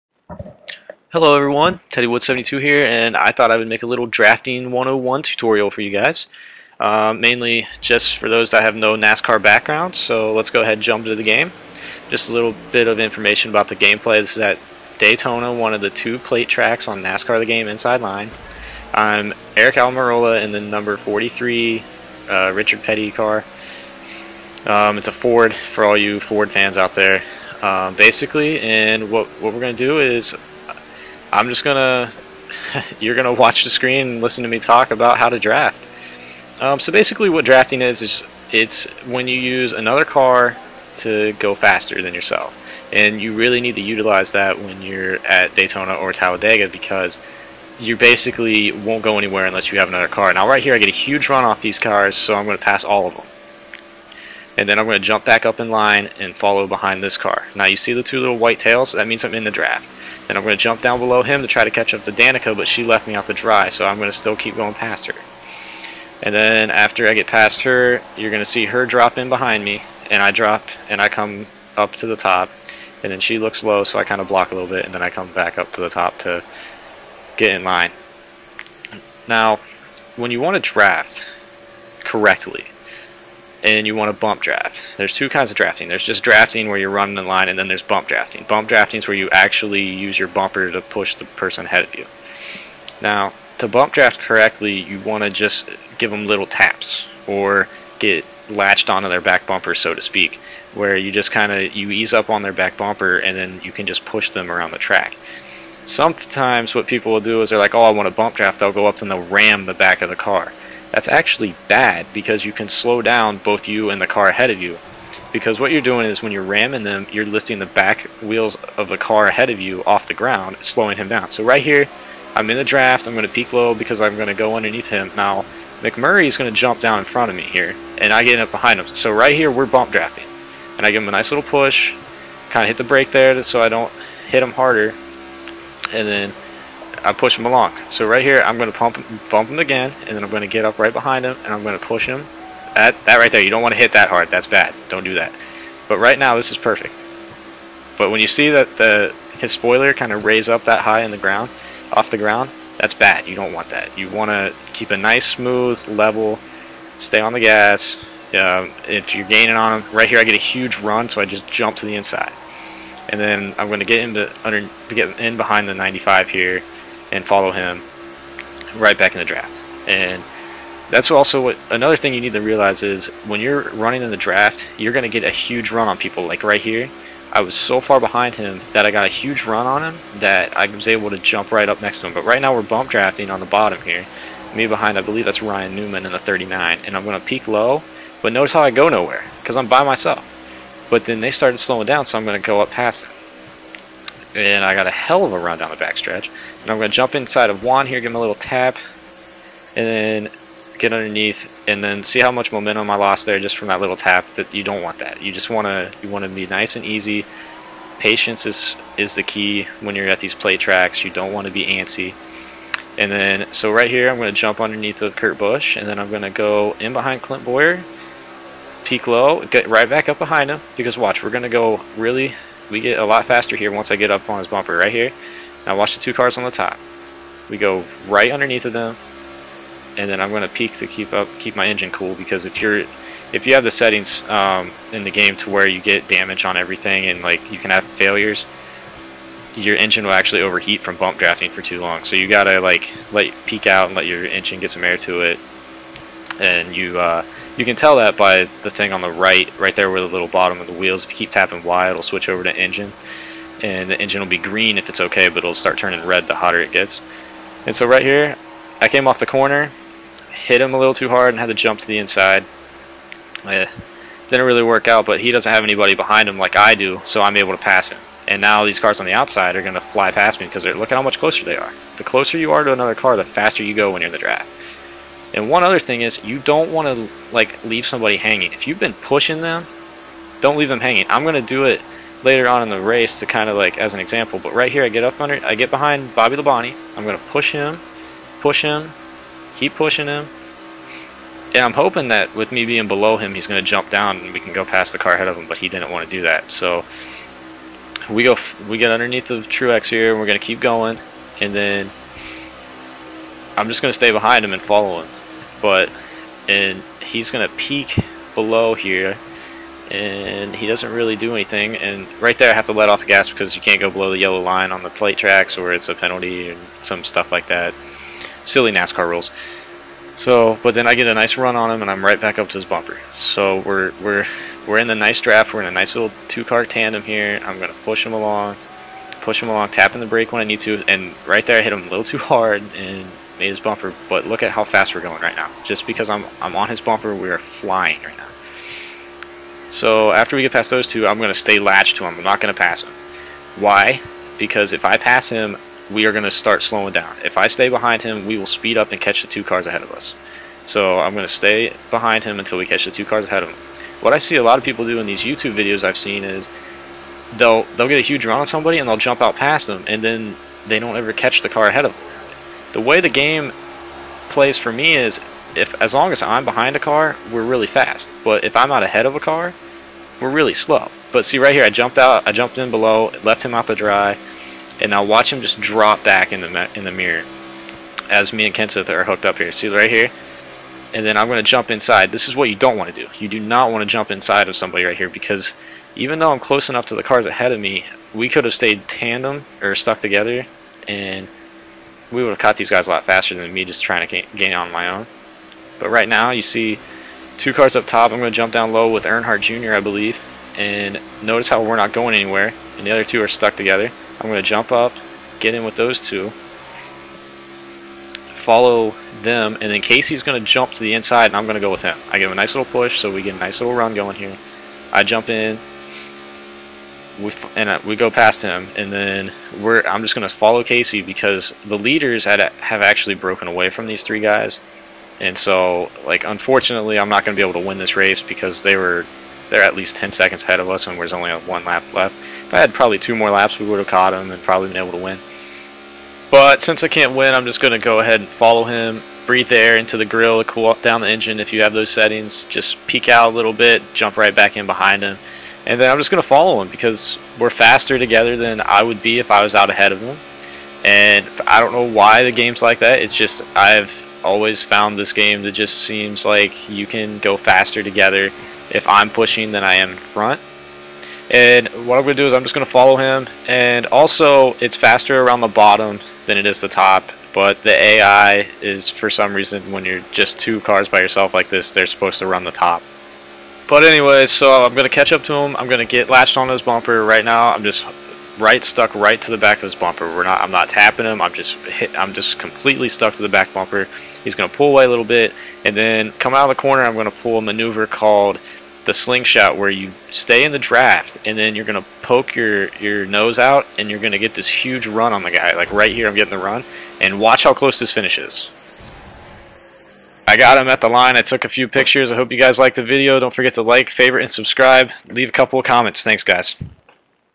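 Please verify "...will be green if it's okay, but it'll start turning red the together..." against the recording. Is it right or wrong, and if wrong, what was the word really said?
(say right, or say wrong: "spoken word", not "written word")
wrong: "hotter", not "together".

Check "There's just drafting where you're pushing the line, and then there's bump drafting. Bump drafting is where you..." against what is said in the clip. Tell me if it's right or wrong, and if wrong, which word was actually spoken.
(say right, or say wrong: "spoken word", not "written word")
wrong: "running", not "pushing".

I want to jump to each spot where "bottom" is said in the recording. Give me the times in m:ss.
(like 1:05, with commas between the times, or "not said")
3:03, 4:10, 7:45.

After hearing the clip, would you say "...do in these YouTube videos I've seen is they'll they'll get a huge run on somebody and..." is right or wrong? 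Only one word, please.
right.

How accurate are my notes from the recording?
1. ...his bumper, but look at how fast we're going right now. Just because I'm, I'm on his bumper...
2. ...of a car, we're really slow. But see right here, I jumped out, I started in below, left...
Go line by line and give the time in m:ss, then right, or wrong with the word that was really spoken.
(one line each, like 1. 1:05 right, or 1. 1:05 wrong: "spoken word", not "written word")
1. 5:33 right
2. 6:09 wrong: "jumped", not "started".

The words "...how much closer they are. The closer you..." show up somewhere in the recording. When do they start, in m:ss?
4:30.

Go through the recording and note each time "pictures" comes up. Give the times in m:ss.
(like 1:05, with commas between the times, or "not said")
8:21.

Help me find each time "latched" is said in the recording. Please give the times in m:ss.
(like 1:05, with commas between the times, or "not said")
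1:38, 5:41, 7:56.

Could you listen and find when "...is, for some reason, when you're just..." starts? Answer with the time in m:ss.
7:48.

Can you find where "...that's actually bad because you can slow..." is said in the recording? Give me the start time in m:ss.
1:50.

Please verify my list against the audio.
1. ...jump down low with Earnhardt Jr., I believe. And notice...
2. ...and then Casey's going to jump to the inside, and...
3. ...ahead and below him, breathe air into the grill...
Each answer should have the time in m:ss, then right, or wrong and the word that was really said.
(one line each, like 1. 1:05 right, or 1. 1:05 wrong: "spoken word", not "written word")
1. 6:38 right
2. 6:49 right
3. 7:17 wrong: "follow", not "below".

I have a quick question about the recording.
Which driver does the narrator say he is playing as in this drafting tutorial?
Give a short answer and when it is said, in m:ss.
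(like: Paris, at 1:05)
Aric Almirola, at 0:19.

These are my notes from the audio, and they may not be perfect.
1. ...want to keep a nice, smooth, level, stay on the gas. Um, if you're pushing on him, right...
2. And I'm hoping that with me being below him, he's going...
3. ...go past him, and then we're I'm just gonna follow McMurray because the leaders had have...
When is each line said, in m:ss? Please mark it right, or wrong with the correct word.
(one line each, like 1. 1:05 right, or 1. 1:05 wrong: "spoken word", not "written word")
1. 2:34 wrong: "gaining", not "pushing"
2. 4:51 right
3. 6:57 wrong: "Casey", not "McMurray".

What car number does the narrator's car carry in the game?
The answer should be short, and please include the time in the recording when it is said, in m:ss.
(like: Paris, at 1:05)
43, at 0:20.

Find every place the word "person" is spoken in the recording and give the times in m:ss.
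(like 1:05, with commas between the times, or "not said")
1:31.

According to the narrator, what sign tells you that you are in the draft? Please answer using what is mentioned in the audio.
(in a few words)
two little white tails.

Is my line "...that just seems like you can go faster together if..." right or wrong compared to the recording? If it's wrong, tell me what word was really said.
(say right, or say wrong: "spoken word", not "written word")
right.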